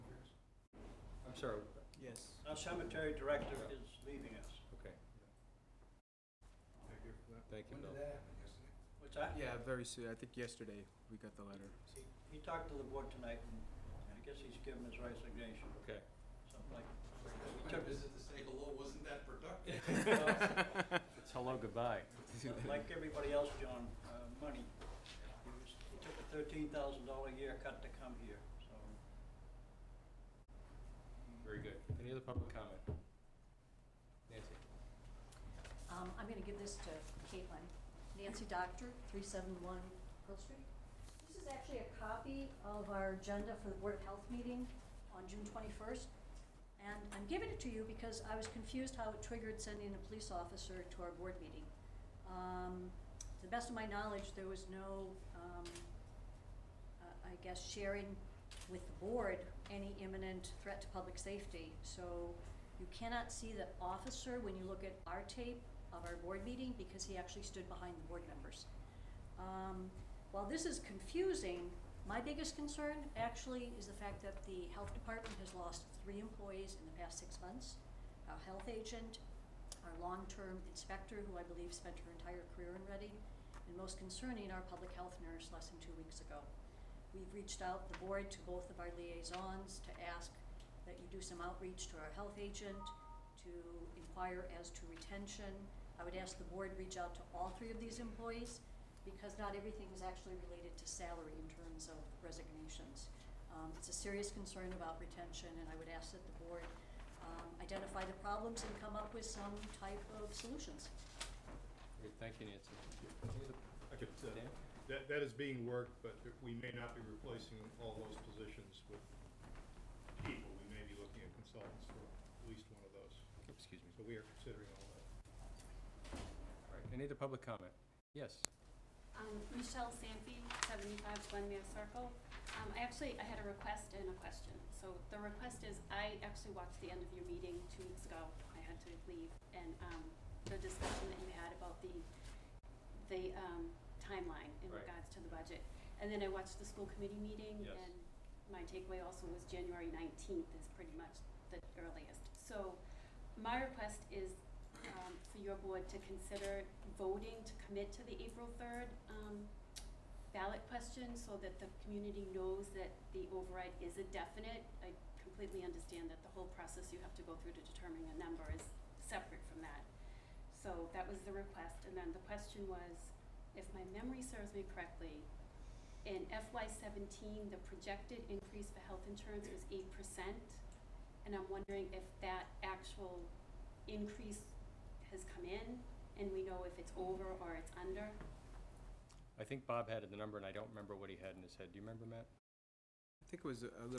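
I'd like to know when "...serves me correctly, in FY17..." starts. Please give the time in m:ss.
2:54.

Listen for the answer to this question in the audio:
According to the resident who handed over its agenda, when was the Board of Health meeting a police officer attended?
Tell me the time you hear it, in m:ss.
0:45.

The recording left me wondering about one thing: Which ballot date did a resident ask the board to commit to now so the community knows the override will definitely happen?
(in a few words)
April 3rd.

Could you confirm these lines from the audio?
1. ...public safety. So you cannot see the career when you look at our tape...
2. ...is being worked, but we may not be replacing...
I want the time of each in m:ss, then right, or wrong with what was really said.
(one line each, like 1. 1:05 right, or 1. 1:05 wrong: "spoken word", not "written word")
1. 1:00 wrong: "officer", not "career"
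2. 1:55 right.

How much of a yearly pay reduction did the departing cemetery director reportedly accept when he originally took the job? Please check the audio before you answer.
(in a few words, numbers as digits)
$13,000.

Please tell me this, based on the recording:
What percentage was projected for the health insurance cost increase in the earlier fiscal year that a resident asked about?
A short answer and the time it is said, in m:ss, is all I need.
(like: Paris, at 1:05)
8%, at 2:59.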